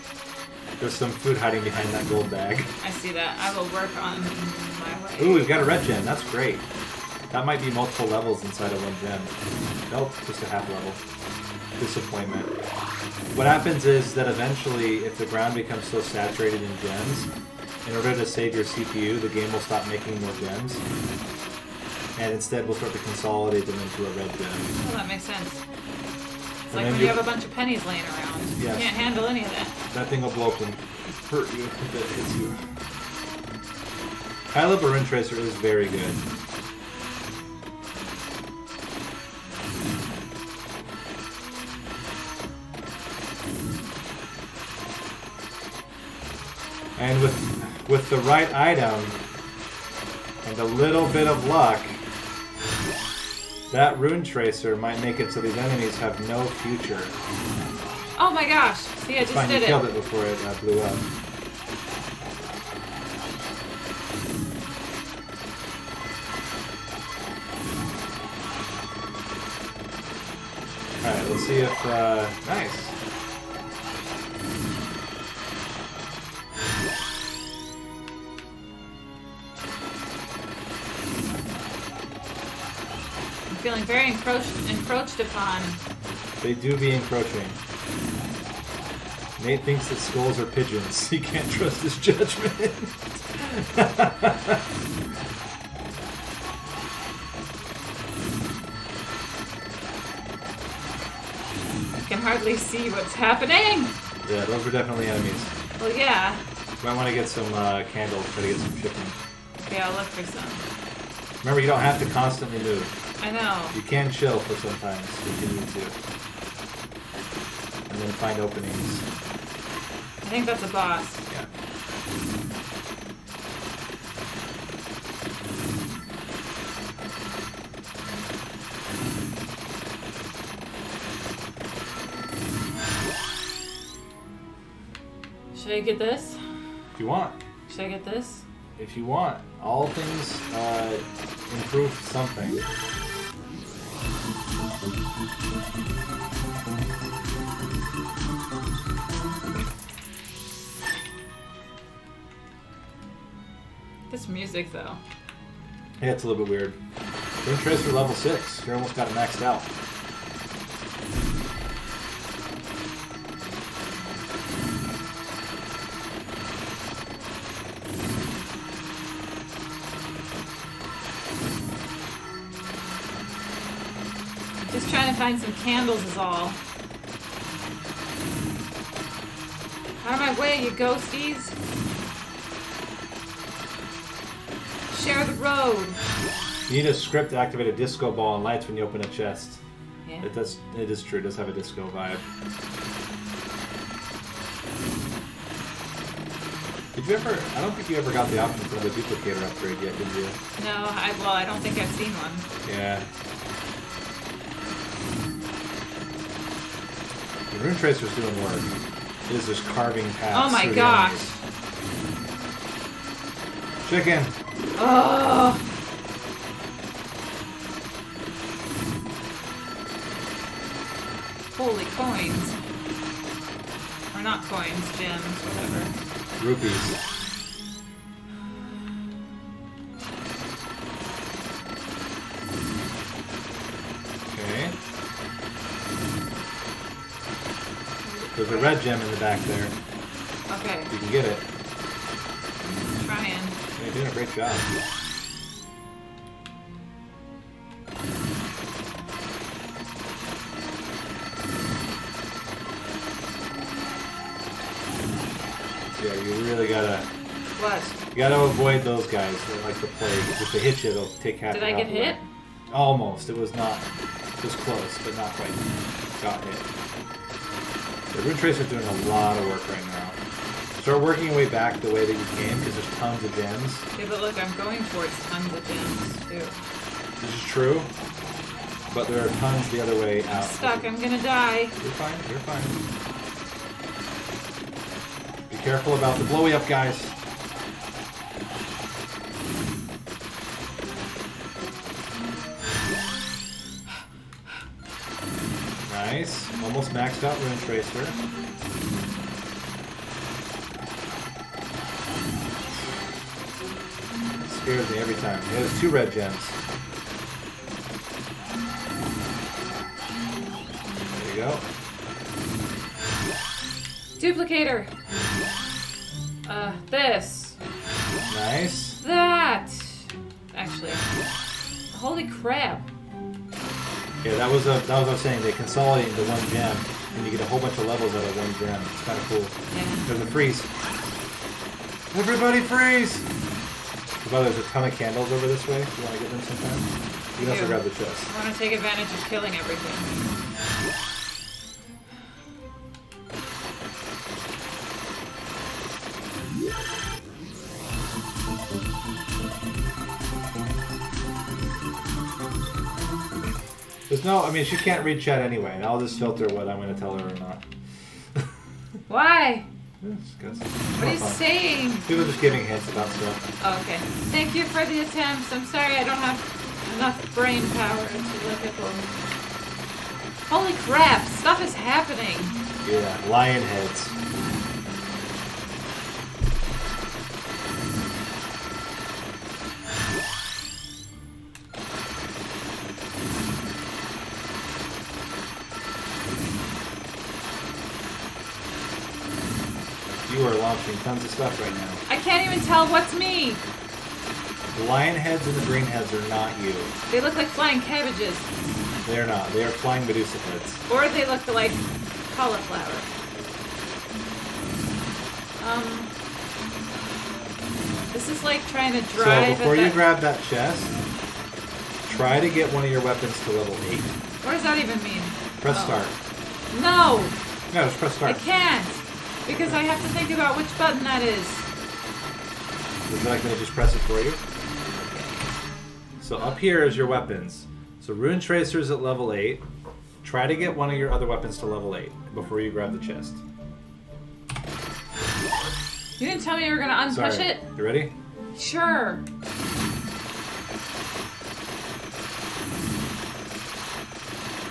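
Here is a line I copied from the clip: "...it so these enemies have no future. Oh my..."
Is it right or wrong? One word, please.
right.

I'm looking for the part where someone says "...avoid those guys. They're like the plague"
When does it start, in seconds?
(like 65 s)
258 s.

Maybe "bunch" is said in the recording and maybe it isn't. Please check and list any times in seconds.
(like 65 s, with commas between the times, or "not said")
27 s, 327 s.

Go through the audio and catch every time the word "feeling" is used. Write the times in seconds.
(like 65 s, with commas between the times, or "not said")
83 s.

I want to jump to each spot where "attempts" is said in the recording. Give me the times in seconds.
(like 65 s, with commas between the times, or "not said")
365 s.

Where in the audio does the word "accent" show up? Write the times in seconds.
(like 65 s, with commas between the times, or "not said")
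not said.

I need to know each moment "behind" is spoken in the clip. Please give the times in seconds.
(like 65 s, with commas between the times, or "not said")
1 s.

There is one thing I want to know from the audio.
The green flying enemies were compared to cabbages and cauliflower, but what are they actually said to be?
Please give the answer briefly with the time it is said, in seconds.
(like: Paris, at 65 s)
Medusa heads, at 400 s.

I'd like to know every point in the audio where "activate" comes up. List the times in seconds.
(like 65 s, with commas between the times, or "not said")
187 s.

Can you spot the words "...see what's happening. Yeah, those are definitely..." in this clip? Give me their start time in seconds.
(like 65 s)
102 s.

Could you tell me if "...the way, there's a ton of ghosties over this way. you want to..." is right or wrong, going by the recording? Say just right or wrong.
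wrong.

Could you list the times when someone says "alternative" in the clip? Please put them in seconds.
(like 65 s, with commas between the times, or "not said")
not said.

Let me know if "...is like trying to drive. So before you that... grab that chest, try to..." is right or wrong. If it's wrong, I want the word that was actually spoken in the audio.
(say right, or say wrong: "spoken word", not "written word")
right.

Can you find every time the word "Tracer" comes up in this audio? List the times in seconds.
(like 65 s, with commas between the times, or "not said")
35 s, 54 s, 207 s, 268 s, 297 s, 428 s.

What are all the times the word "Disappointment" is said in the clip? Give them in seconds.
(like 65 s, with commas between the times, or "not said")
11 s.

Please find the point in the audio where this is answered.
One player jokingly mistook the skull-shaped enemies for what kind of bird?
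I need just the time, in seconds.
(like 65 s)
90 s.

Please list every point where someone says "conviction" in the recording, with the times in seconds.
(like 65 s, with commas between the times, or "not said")
not said.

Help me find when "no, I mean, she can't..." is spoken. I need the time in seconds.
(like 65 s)
354 s.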